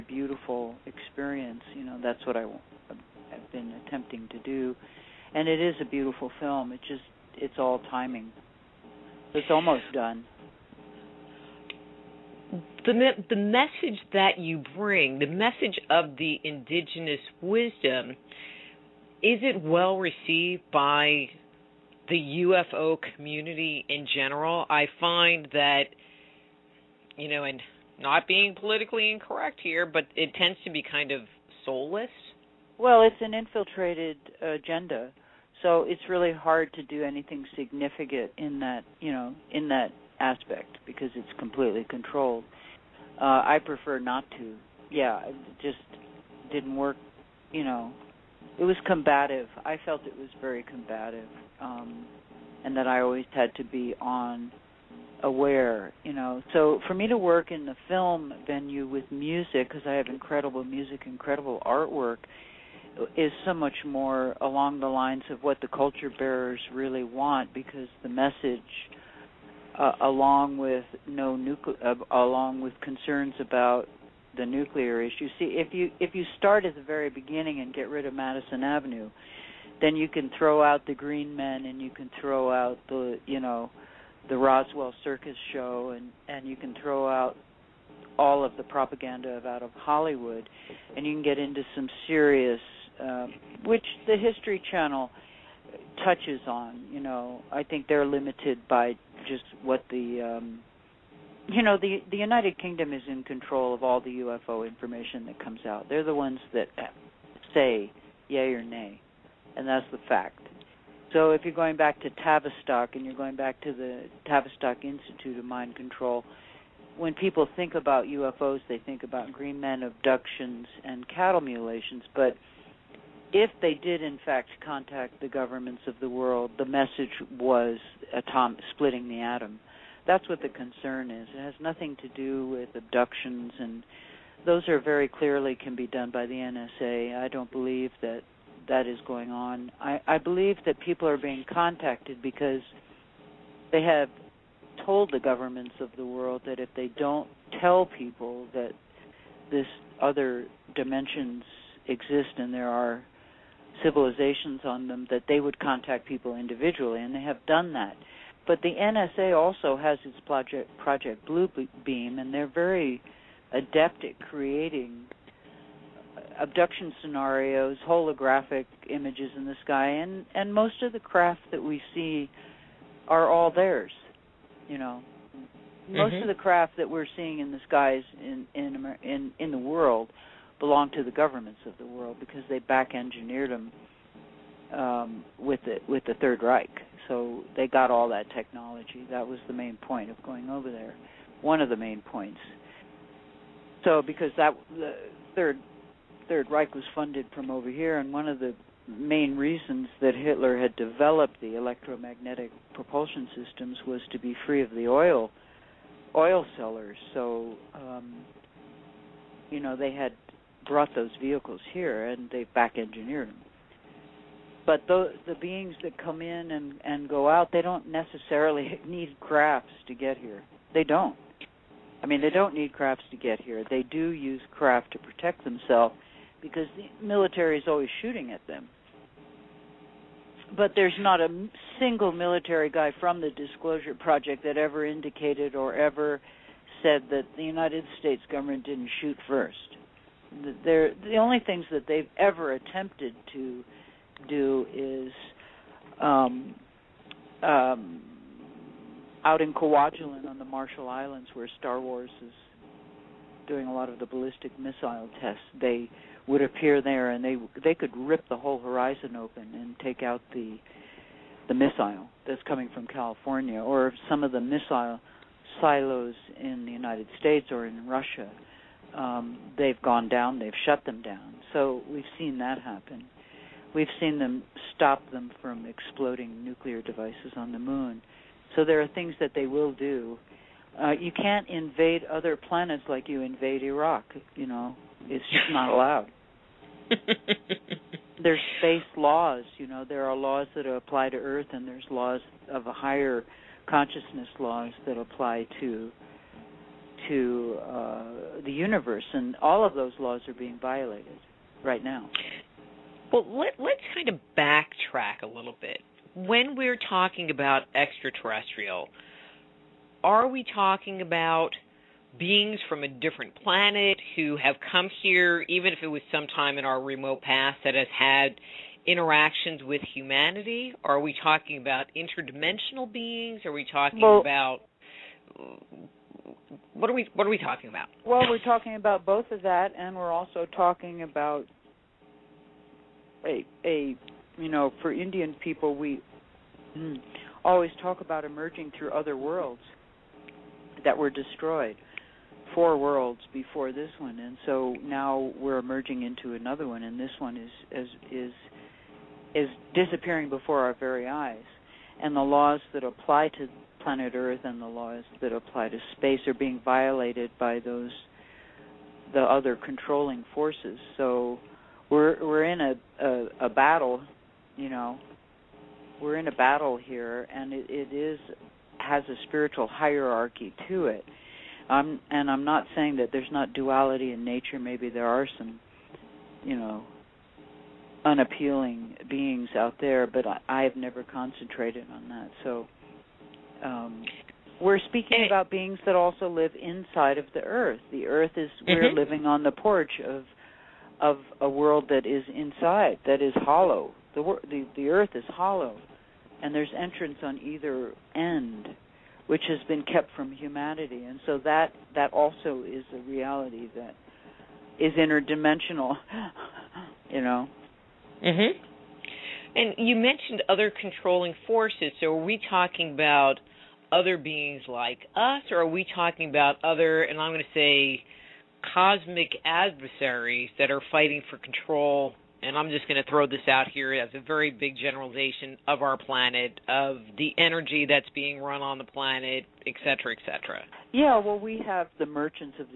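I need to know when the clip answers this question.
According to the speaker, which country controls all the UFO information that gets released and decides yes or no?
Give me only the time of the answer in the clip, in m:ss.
1:42.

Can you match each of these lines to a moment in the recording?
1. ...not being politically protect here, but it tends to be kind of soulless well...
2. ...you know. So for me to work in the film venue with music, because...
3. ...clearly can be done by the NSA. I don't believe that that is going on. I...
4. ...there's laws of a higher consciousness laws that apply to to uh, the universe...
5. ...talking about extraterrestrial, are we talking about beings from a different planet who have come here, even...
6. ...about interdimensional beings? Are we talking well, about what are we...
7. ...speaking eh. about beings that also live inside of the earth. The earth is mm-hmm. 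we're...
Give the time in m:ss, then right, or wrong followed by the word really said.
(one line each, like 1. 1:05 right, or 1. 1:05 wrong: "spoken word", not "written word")
1. 0:27 wrong: "incorrect", not "protect"
2. 0:56 right
3. 2:15 right
4. 4:51 right
5. 5:06 right
6. 5:21 right
7. 6:24 right.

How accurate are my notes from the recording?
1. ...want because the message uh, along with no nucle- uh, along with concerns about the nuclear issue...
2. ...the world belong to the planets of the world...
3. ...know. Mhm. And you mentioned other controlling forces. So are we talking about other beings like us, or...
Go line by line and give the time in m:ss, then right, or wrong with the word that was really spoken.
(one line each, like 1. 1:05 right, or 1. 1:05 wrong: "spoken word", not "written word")
1. 1:07 right
2. 2:59 wrong: "governments", not "planets"
3. 6:47 right.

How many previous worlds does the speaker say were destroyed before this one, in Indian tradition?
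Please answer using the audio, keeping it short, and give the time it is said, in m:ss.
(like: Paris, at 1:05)
4, at 5:42.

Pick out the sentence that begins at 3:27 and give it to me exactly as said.
So um, you know they had brought those vehicles here and they back engineered them.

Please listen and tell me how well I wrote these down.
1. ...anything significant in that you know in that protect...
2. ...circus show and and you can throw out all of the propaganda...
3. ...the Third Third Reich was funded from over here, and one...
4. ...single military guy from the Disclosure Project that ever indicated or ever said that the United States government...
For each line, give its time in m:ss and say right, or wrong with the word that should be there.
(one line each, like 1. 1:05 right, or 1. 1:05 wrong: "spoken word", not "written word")
1. 0:37 wrong: "aspect", not "protect"
2. 1:25 right
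3. 3:14 right
4. 3:51 right.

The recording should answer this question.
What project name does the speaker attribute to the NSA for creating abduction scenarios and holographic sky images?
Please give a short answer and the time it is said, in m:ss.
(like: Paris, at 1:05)
Project Beam, at 2:40.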